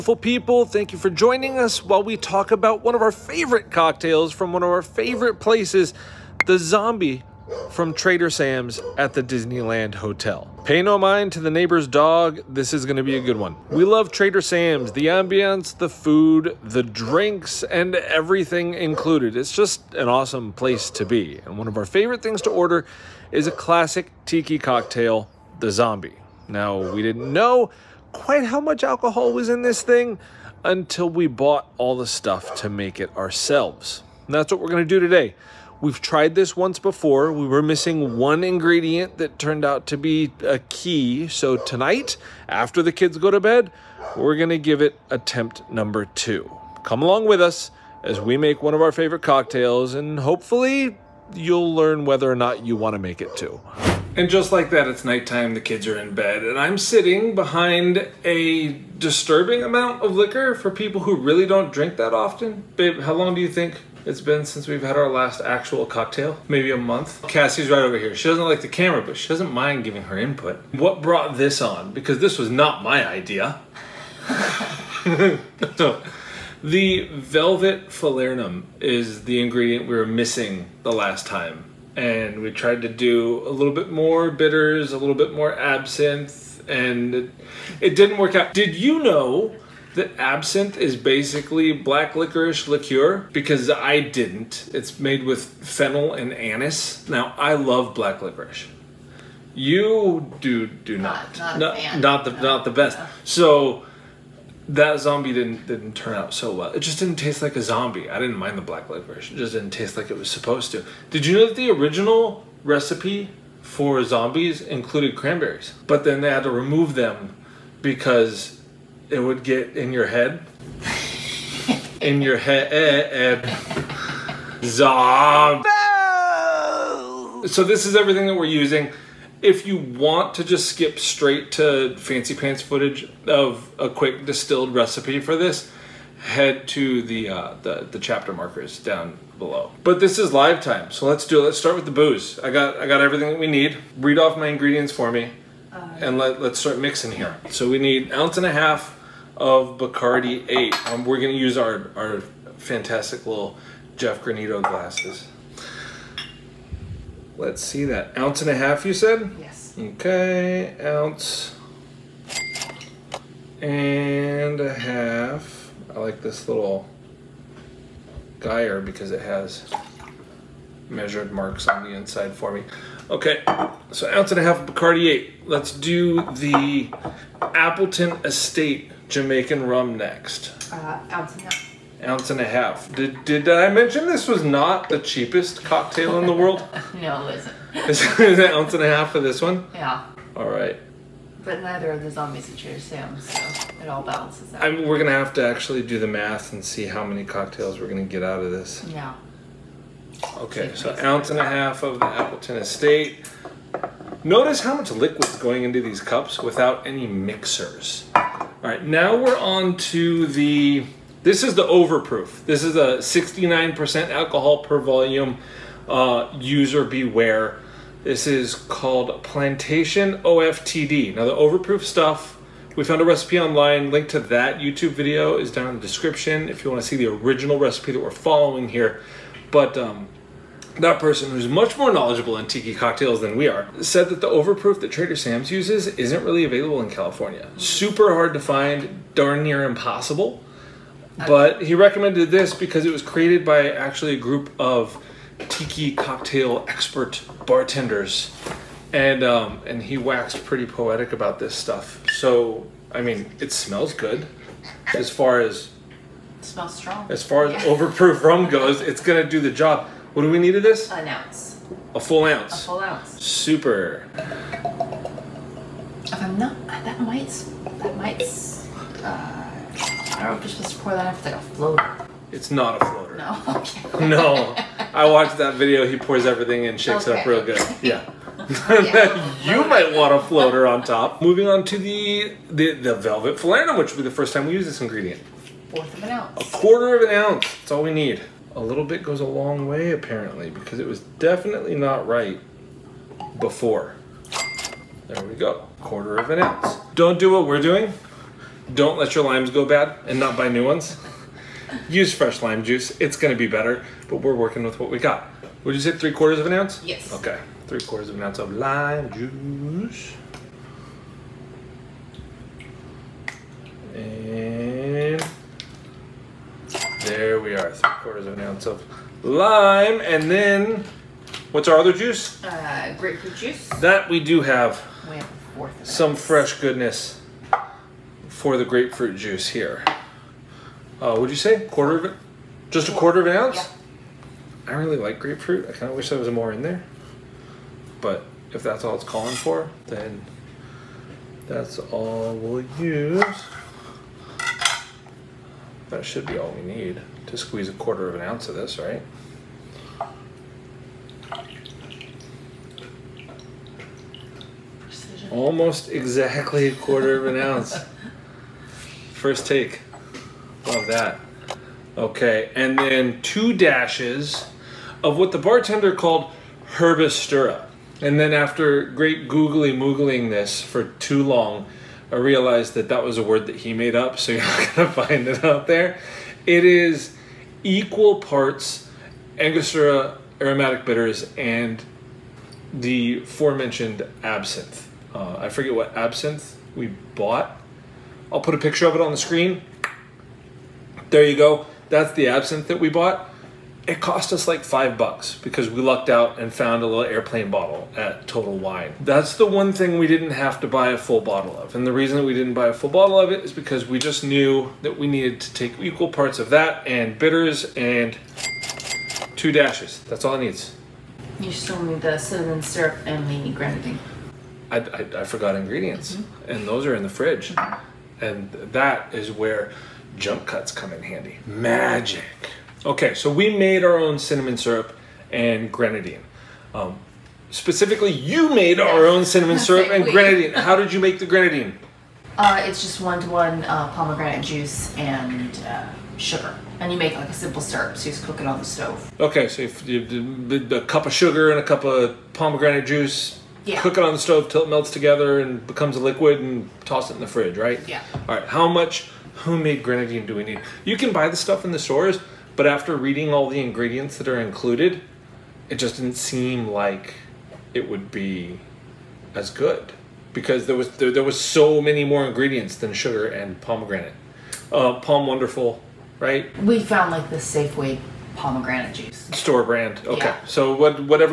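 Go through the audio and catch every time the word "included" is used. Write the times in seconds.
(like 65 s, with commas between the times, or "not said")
18 s, 114 s, 454 s.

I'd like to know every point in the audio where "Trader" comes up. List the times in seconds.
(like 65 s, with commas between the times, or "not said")
7 s, 14 s, 234 s.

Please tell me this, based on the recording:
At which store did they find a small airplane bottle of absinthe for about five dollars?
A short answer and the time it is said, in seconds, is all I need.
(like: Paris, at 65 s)
Total Wine, at 398 s.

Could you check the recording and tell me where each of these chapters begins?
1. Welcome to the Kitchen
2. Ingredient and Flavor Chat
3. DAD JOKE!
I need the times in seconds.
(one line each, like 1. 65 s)
1. 54 s
2. 75 s
3. 110 s.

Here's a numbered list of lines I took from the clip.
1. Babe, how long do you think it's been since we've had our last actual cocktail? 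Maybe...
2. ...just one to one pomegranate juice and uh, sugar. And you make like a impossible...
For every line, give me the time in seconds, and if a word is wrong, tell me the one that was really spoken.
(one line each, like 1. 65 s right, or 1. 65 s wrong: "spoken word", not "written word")
1. 62 s right
2. 432 s wrong: "simple", not "impossible".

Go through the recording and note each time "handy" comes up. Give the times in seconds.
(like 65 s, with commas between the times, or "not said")
421 s.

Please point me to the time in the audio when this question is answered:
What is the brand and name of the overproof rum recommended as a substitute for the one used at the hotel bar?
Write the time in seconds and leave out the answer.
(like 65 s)
219 s.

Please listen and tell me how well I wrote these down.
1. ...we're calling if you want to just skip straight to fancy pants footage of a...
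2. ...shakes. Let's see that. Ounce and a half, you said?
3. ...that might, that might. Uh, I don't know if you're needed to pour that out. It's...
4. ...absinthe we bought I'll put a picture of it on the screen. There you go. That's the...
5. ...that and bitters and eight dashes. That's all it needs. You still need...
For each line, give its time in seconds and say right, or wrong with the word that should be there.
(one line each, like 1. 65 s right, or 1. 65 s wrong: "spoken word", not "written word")
1. 128 s wrong: "using", not "calling"
2. 154 s wrong: "glasses", not "shakes"
3. 266 s wrong: "supposed", not "needed"
4. 385 s right
5. 406 s wrong: "two", not "eight".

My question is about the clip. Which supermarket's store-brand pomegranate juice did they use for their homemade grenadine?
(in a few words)
Safeway.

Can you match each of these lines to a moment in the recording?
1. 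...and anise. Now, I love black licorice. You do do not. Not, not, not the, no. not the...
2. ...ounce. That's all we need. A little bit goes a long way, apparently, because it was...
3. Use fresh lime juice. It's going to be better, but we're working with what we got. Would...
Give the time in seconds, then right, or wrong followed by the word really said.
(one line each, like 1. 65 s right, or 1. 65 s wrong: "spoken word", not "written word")
1. 96 s right
2. 287 s right
3. 301 s right.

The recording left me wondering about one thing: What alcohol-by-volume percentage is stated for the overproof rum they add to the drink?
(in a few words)
69%.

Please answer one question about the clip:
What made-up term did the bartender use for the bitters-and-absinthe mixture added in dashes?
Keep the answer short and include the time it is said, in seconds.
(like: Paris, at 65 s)
Herbistura, at 366 s.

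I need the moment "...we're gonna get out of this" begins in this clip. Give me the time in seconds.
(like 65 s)
197 s.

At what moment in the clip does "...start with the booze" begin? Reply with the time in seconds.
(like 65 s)
141 s.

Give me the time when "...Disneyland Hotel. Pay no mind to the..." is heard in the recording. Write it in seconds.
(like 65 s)
9 s.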